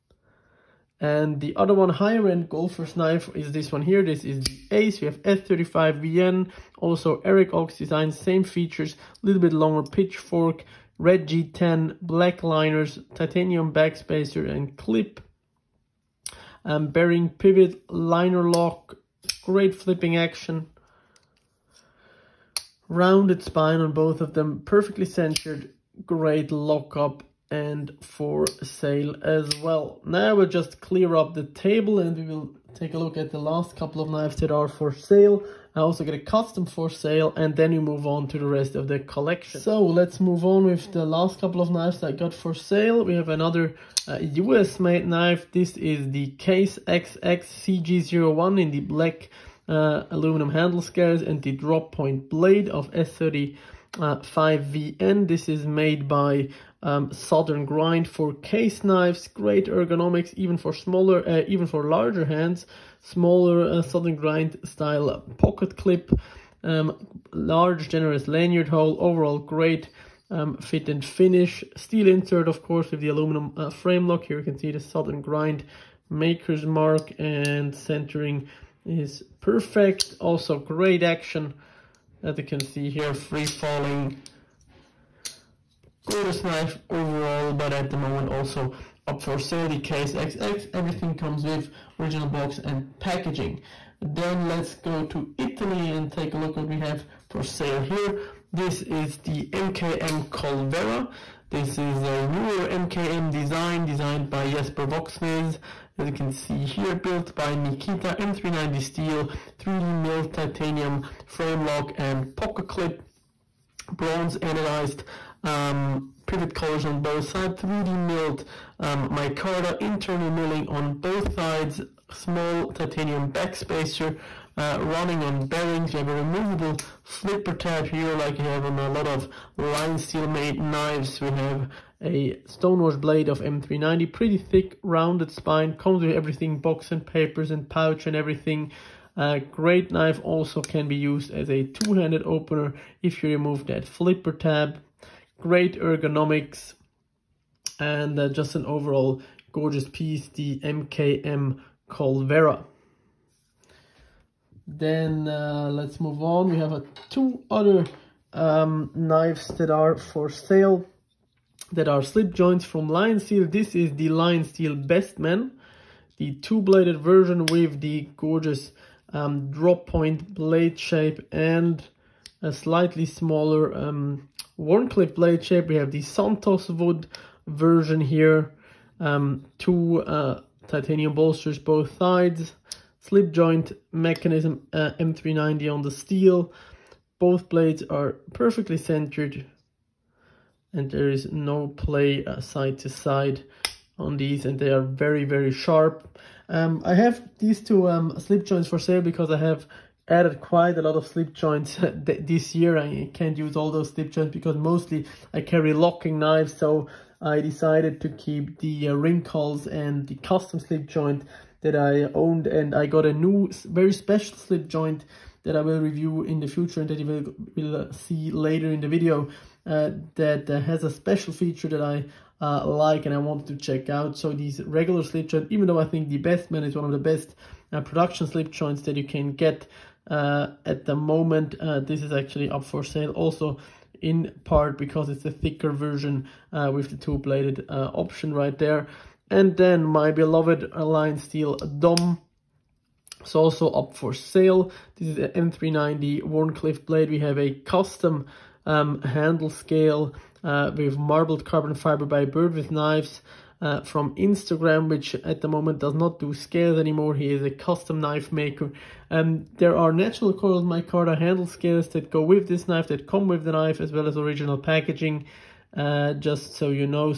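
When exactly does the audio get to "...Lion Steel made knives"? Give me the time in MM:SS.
02:09.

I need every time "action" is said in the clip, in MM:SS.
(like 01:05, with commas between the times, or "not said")
00:20, 01:21.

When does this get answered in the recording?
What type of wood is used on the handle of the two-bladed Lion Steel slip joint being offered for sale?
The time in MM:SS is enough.
02:56.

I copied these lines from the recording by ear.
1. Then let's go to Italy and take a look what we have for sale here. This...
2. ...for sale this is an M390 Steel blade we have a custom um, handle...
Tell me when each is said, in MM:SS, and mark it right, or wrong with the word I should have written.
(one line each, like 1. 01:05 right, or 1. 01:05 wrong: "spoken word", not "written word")
1. 01:33 right
2. 04:03 wrong: "Wharncliffe", not "Steel".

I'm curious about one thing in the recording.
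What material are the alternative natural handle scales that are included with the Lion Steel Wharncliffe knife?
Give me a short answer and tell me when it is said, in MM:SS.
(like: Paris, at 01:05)
coiled micarta, at 04:20.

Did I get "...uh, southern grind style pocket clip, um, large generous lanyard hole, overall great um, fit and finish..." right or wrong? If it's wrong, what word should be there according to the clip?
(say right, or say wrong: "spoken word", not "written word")
right.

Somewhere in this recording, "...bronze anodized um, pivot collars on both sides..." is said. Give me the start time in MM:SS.
01:53.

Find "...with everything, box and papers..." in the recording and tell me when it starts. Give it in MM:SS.
02:16.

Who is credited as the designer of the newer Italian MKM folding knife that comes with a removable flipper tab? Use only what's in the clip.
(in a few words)
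Jesper Voxnes.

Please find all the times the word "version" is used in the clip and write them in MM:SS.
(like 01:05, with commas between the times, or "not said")
02:46, 02:57, 03:55.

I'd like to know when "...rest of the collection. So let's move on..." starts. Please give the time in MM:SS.
00:38.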